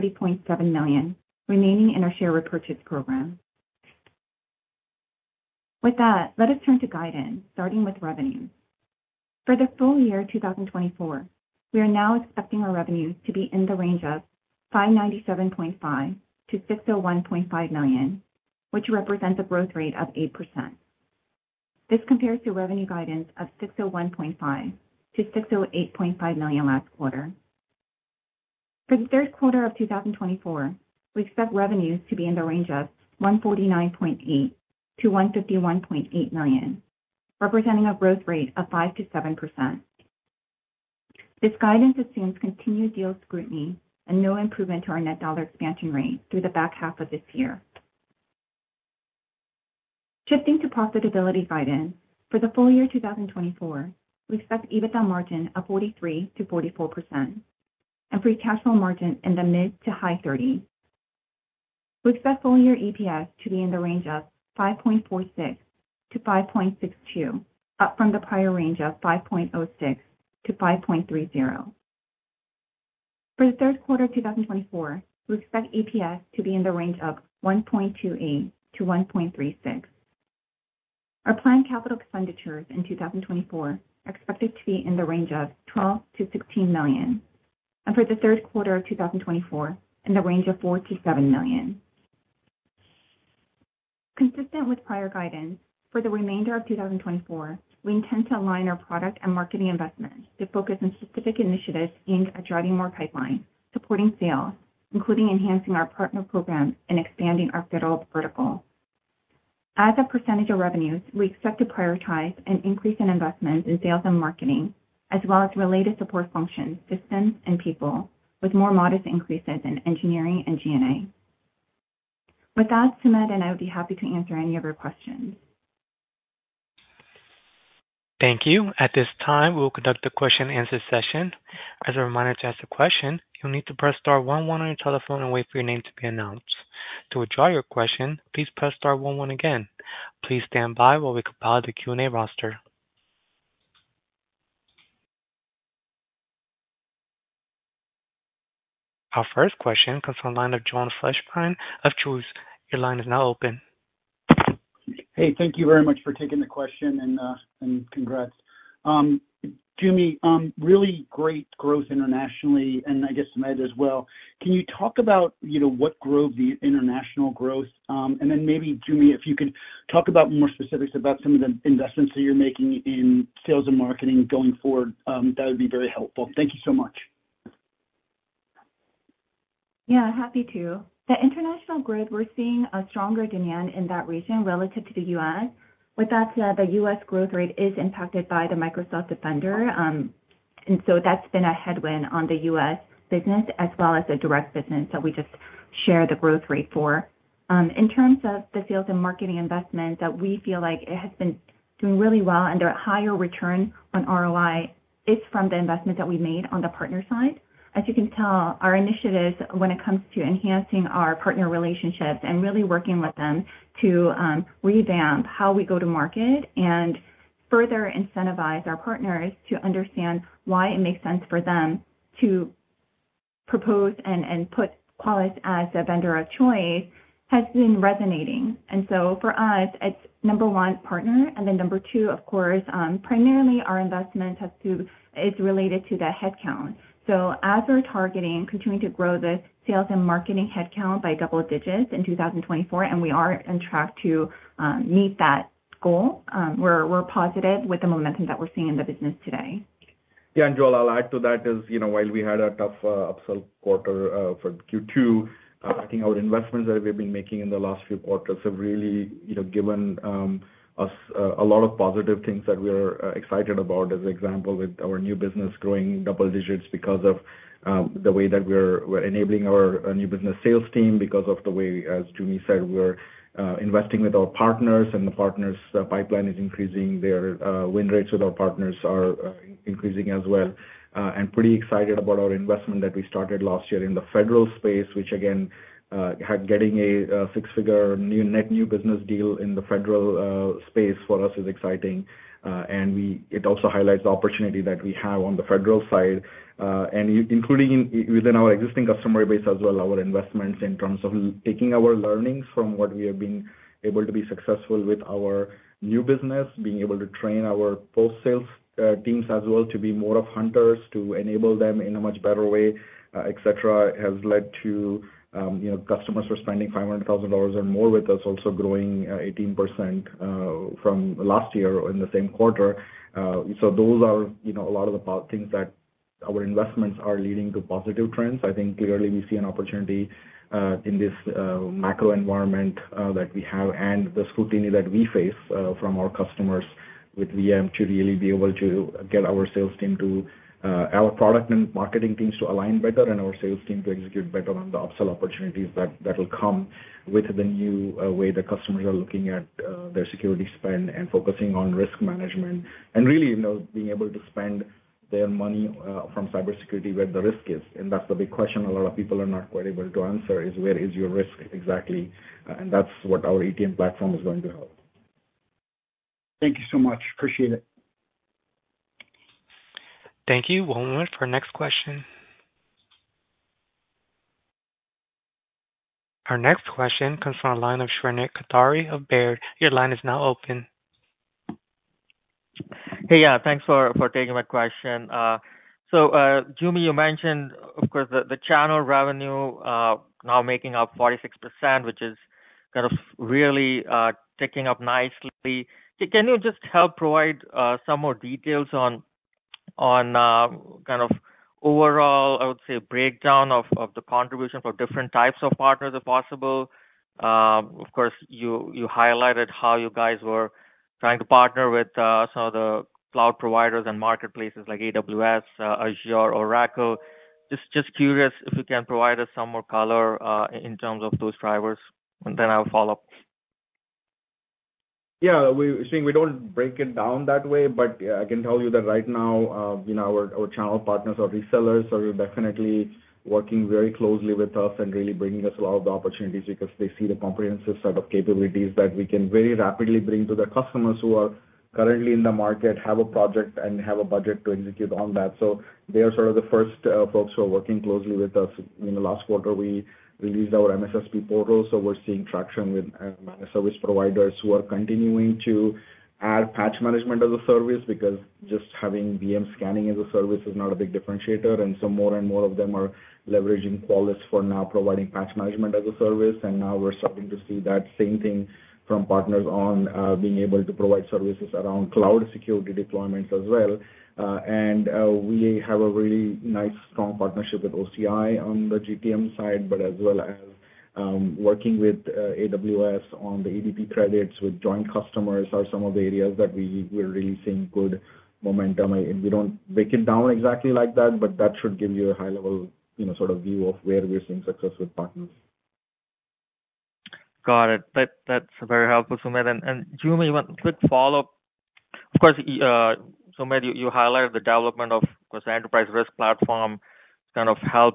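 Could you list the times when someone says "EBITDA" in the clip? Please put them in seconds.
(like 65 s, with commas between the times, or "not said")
54 s.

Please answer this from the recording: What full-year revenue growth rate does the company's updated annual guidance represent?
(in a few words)
8%.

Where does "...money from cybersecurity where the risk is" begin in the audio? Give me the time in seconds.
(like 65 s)
355 s.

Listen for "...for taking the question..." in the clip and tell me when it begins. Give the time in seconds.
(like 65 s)
156 s.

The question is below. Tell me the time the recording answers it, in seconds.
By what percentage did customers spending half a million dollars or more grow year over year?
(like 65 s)
319 s.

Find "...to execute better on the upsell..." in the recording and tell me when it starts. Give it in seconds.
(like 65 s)
343 s.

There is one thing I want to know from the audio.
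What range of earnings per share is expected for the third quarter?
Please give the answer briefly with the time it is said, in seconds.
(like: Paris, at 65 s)
$1.28-$1.36, at 77 s.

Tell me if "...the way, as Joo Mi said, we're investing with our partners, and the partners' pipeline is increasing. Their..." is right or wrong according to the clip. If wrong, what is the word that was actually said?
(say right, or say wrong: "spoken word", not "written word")
right.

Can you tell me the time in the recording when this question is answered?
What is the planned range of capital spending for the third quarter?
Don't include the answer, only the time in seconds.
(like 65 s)
90 s.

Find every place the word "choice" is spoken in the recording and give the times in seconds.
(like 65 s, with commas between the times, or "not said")
226 s.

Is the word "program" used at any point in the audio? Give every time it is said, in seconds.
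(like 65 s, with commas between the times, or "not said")
2 s, 106 s.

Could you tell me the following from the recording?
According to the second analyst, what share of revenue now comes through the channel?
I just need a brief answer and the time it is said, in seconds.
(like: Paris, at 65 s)
46%, at 390 s.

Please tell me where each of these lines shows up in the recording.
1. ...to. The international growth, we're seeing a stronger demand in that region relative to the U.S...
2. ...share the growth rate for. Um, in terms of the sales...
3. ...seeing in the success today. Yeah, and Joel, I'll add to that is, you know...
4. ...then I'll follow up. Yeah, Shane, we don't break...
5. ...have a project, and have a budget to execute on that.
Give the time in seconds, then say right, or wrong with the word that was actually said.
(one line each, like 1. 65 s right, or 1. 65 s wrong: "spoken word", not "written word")
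1. 180 s right
2. 195 s right
3. 248 s wrong: "business", not "success"
4. 422 s right
5. 442 s right.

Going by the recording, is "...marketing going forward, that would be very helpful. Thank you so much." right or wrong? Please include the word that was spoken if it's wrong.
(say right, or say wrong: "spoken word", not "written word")
right.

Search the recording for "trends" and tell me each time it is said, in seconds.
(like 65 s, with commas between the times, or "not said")
328 s.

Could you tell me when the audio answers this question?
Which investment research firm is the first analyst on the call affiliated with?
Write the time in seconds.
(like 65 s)
152 s.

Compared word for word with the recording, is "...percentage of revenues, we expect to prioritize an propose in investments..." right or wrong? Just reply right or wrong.
wrong.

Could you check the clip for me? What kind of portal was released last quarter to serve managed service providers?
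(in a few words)
MSSP portal.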